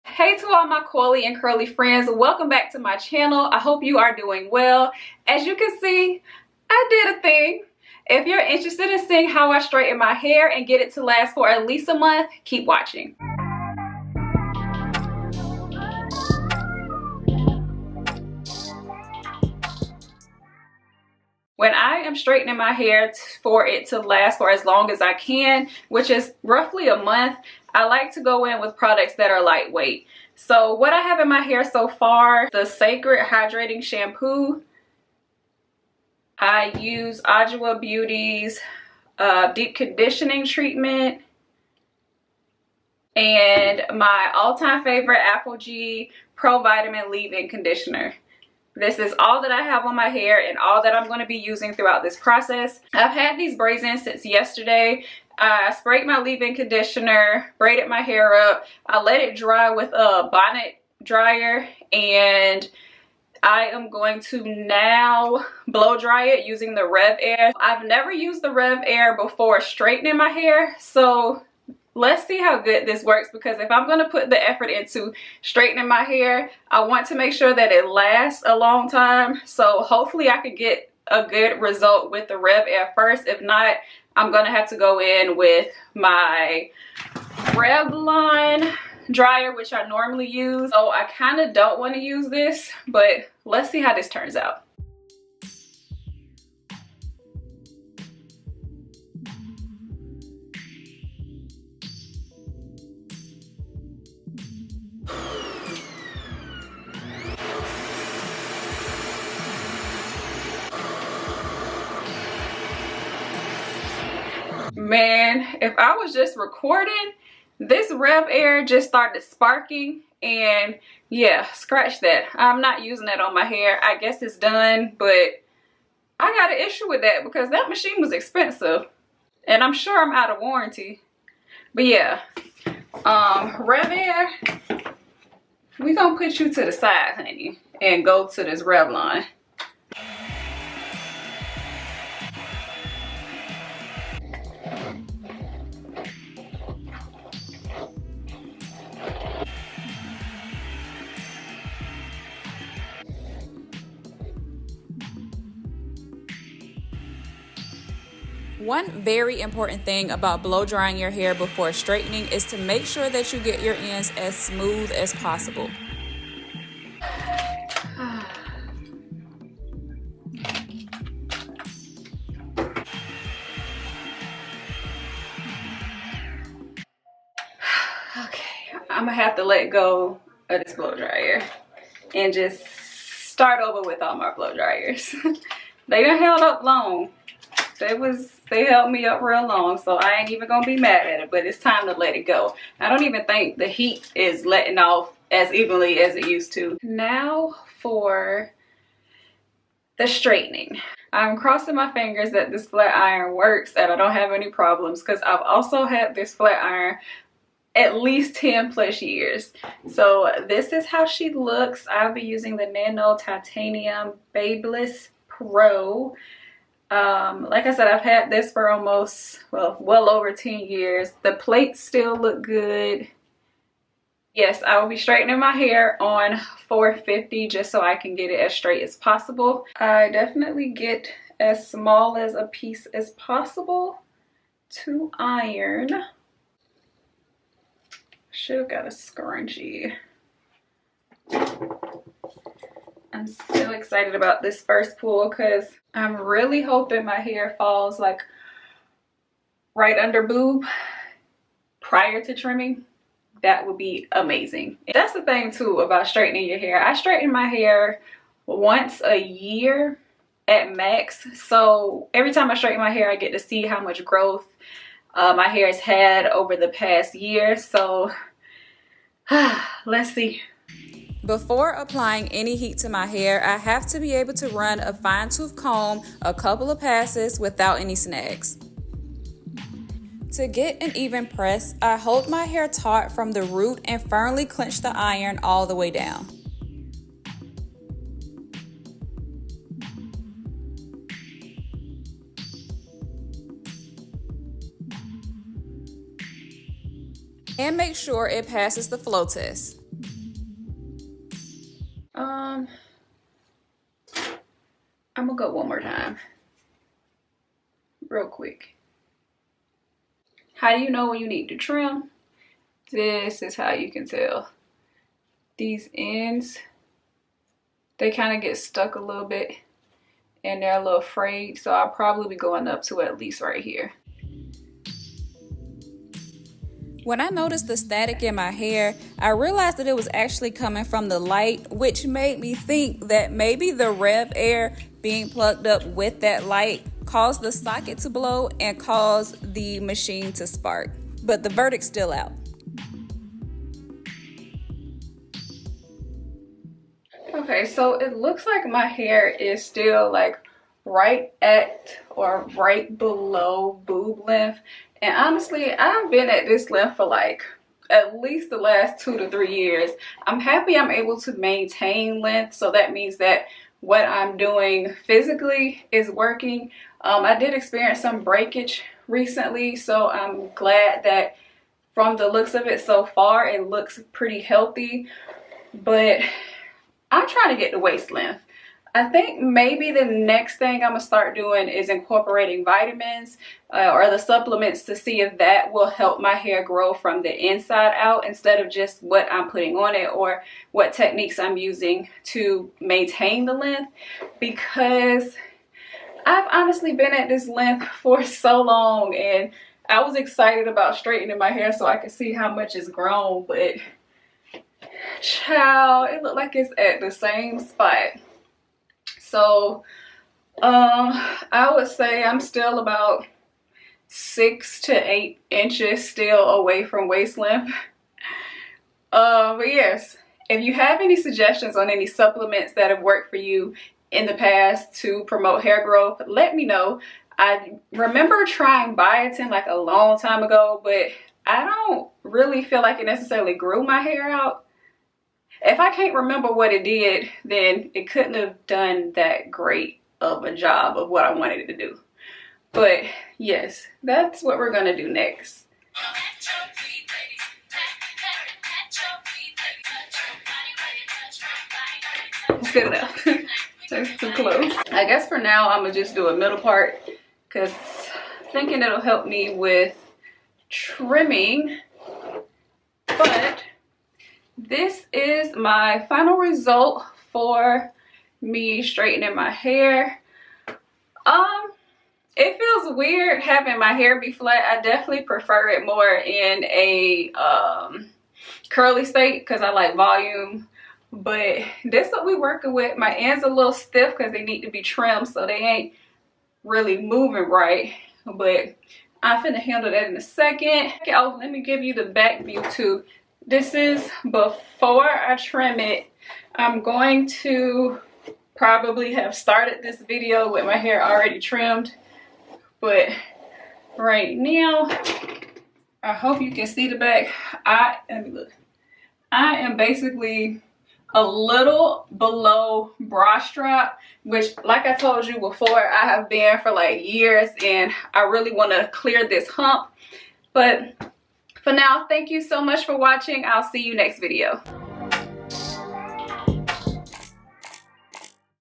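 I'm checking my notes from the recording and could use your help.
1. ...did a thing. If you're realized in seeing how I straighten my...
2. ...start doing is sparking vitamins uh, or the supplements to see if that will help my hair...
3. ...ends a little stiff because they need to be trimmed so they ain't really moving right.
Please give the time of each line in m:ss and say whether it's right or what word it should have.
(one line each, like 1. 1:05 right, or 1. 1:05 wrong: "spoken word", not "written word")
1. 0:06 wrong: "interested", not "realized"
2. 6:21 wrong: "incorporating", not "sparking"
3. 8:03 right.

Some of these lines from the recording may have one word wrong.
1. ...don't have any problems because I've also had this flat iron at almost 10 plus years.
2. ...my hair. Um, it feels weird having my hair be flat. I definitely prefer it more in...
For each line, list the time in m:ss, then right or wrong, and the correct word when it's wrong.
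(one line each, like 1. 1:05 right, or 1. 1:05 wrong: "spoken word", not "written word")
1. 3:23 wrong: "least", not "almost"
2. 7:49 right.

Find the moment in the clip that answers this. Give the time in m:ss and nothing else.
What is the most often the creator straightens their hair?
4:18.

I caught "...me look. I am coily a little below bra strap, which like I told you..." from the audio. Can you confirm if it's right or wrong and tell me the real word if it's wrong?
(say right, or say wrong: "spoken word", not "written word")
wrong: "basically", not "coily".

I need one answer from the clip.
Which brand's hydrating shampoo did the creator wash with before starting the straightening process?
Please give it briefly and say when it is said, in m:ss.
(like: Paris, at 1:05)
Cecred, at 0:32.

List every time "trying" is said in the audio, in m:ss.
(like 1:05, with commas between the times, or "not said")
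6:17, 7:08.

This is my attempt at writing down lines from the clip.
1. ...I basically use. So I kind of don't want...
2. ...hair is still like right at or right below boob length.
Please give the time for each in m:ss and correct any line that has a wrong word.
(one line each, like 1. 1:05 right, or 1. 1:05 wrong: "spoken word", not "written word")
1. 1:29 wrong: "normally", not "basically"
2. 5:48 right.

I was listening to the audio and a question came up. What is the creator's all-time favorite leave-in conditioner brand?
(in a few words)
ApHogee.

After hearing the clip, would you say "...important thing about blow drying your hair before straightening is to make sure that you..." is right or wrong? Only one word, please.
right.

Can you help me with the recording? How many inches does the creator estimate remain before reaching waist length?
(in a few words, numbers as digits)
6 to 8.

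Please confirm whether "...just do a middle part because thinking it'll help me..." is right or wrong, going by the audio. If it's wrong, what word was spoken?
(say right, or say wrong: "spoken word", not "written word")
right.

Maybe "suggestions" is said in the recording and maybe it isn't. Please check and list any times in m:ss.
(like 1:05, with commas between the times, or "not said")
7:01.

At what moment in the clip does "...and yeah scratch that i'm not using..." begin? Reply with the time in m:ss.
2:00.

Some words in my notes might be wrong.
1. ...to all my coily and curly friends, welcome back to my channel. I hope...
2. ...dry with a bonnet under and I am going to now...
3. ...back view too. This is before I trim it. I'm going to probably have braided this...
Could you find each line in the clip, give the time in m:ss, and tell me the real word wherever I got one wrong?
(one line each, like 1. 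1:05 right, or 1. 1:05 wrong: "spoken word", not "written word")
1. 0:00 right
2. 0:59 wrong: "dryer", not "under"
3. 8:12 wrong: "started", not "braided".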